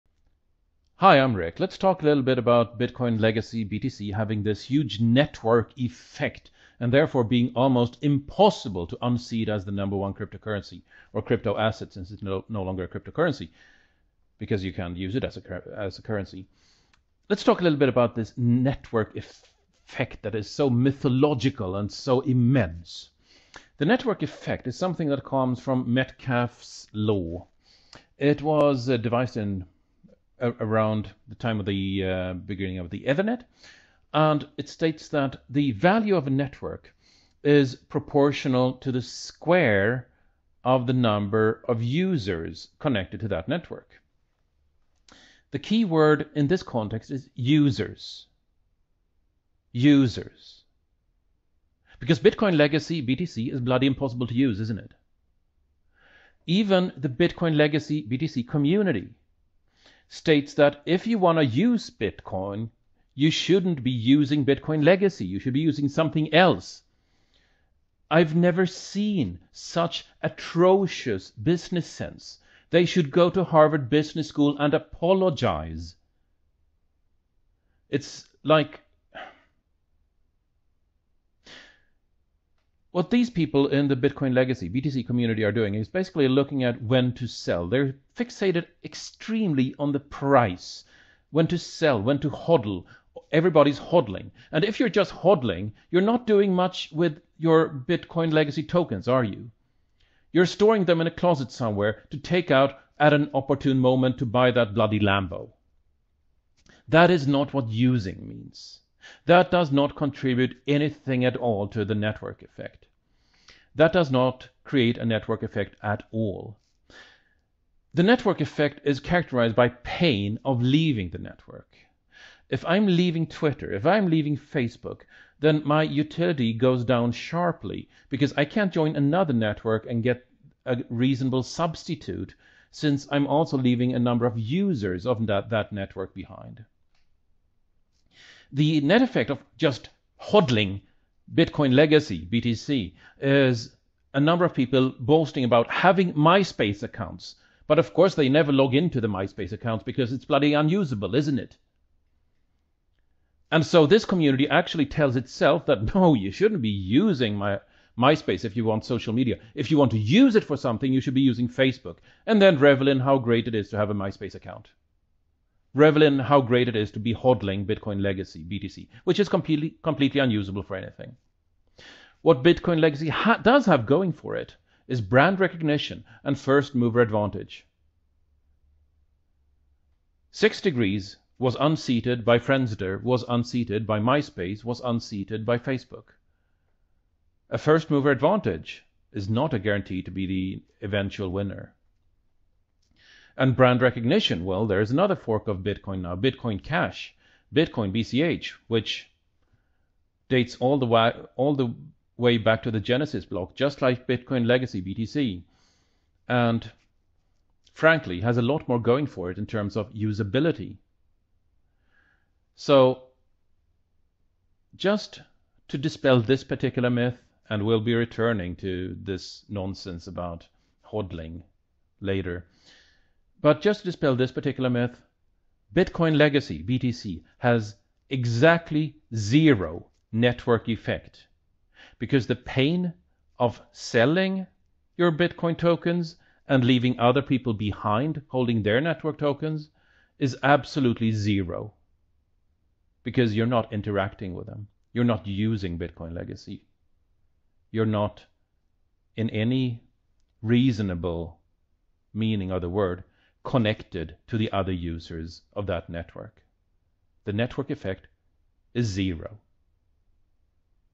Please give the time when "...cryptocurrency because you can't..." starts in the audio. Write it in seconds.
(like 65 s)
12 s.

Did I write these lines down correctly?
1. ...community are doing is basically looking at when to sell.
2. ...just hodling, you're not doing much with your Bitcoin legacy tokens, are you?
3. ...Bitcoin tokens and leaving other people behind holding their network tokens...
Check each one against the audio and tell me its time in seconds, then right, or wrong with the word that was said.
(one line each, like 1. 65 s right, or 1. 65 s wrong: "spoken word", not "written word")
1. 85 s right
2. 94 s right
3. 235 s right.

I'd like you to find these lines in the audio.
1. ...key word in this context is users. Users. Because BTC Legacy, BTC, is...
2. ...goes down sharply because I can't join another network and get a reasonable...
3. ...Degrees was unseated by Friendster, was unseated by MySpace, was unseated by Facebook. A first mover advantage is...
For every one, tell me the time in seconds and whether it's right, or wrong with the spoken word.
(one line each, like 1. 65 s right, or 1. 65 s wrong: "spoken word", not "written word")
1. 45 s wrong: "Bitcoin", not "BTC"
2. 126 s right
3. 180 s right.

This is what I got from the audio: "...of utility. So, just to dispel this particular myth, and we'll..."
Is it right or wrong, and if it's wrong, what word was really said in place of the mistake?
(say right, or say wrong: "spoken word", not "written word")
wrong: "usability", not "utility".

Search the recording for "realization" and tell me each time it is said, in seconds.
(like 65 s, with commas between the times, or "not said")
not said.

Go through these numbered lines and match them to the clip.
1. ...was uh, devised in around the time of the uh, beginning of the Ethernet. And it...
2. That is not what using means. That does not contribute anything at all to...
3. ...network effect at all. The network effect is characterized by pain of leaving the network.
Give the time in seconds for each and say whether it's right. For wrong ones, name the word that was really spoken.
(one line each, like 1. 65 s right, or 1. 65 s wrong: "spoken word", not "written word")
1. 28 s right
2. 106 s right
3. 115 s right.